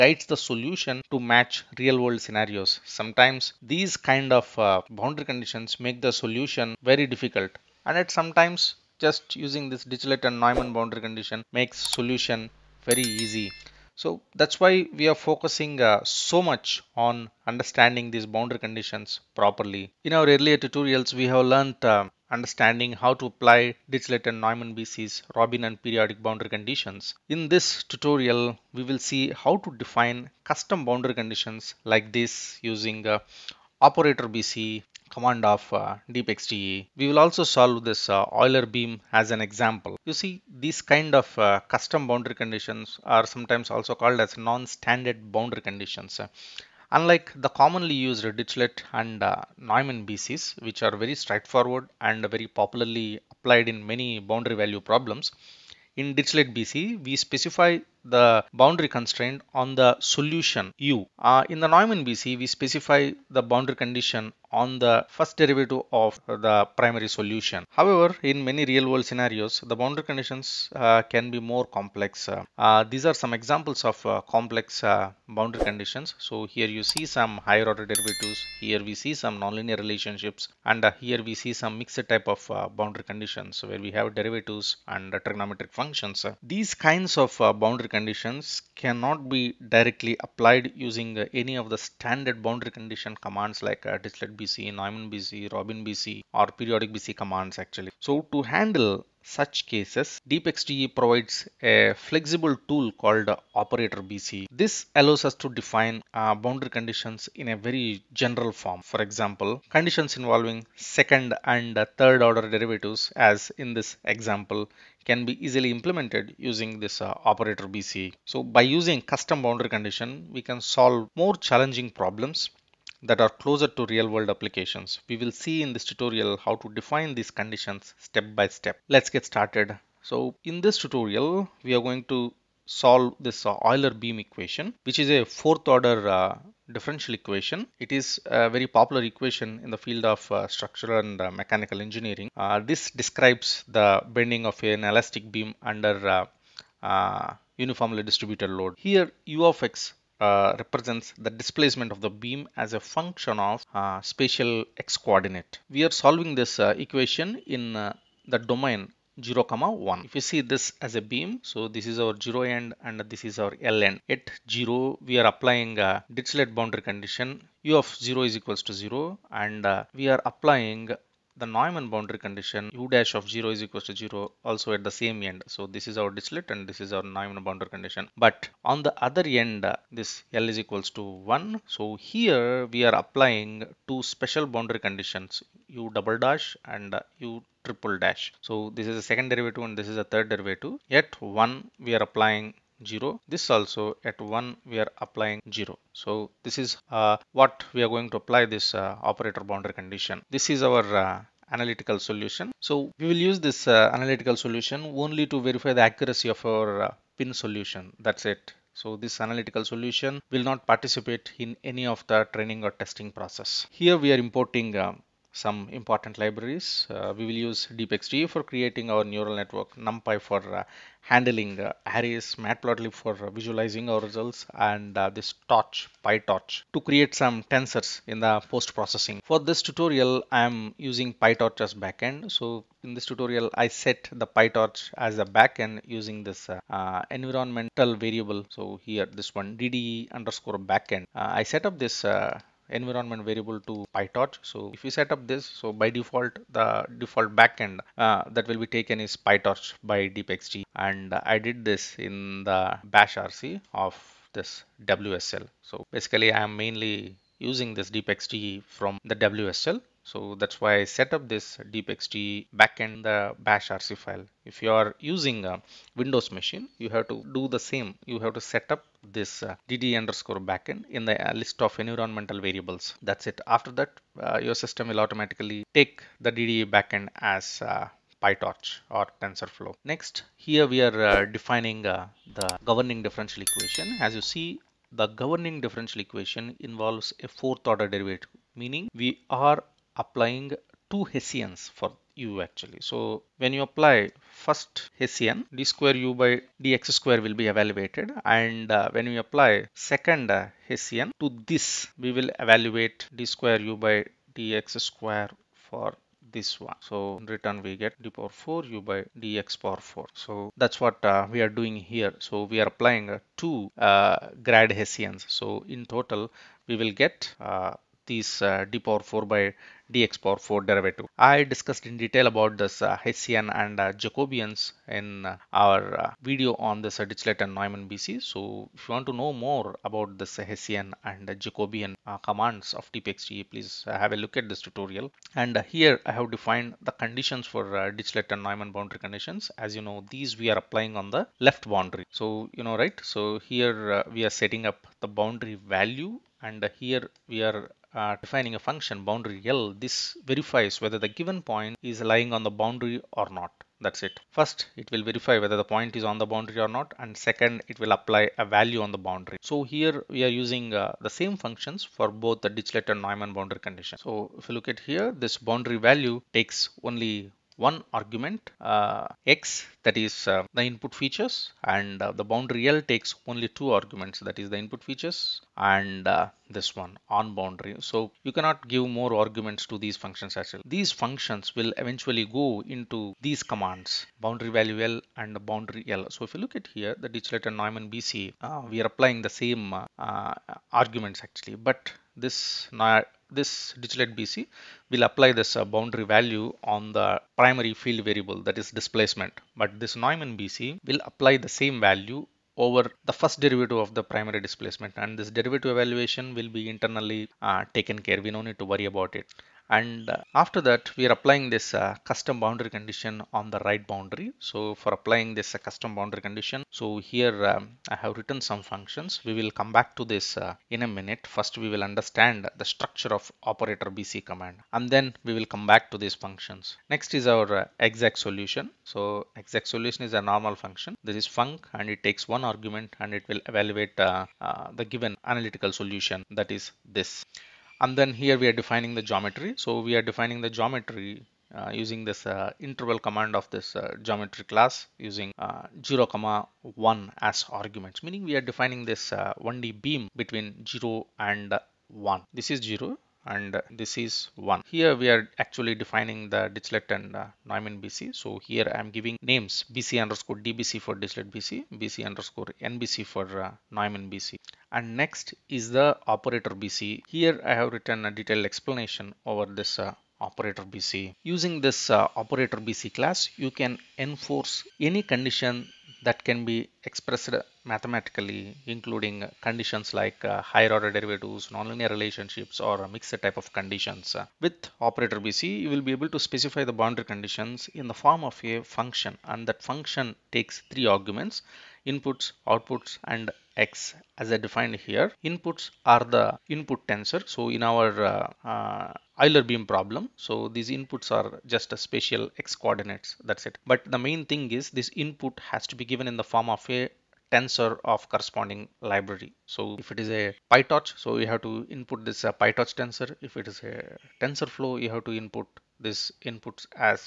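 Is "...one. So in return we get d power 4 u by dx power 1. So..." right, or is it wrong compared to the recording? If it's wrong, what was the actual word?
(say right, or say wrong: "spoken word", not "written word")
wrong: "4", not "1".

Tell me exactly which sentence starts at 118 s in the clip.
So by using custom boundary condition, we can solve more challenging problems that are closer to real world applications.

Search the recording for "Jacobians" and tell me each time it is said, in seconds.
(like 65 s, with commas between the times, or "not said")
323 s, 331 s.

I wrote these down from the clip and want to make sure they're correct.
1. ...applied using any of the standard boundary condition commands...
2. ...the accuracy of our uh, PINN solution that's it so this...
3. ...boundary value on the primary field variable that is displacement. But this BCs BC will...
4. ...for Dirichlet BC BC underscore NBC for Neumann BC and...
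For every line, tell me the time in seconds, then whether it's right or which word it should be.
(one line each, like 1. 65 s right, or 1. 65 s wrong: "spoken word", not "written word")
1. 90 s right
2. 205 s right
3. 395 s wrong: "Neumann", not "BCs"
4. 460 s right.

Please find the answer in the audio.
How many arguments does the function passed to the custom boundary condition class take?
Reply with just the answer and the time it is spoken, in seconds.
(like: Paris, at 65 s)
3, at 490 s.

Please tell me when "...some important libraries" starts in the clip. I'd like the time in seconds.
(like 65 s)
215 s.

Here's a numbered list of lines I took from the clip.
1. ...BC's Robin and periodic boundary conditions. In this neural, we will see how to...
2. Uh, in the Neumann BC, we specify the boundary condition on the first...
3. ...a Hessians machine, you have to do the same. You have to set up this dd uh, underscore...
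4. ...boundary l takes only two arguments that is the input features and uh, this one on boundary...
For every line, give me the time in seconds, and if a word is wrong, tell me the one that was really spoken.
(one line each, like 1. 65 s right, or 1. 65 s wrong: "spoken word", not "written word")
1. 24 s wrong: "tutorial", not "neural"
2. 61 s right
3. 265 s wrong: "Windows", not "Hessians"
4. 372 s right.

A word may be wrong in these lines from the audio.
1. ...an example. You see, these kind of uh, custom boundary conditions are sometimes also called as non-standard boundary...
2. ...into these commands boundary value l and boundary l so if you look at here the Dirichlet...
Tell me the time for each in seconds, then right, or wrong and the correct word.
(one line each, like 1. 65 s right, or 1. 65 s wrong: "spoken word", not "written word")
1. 39 s right
2. 382 s right.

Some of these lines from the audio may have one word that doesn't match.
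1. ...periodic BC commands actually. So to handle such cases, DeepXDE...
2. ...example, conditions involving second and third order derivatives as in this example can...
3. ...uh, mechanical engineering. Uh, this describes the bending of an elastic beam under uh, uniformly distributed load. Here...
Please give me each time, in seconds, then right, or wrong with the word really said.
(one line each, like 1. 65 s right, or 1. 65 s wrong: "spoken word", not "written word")
1. 96 s right
2. 109 s right
3. 141 s right.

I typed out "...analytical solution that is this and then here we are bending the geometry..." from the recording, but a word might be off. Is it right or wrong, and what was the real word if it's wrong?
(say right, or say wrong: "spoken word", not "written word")
wrong: "defining", not "bending".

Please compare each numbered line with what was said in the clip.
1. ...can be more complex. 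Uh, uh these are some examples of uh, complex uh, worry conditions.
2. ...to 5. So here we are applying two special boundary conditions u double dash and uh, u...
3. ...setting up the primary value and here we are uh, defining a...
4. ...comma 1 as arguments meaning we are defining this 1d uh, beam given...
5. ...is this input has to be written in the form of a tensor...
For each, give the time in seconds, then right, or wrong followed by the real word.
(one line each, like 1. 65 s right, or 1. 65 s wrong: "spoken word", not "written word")
1. 71 s wrong: "boundary", not "worry"
2. 180 s wrong: "1", not "5"
3. 344 s wrong: "boundary", not "primary"
4. 446 s wrong: "between", not "given"
5. 504 s wrong: "given", not "written".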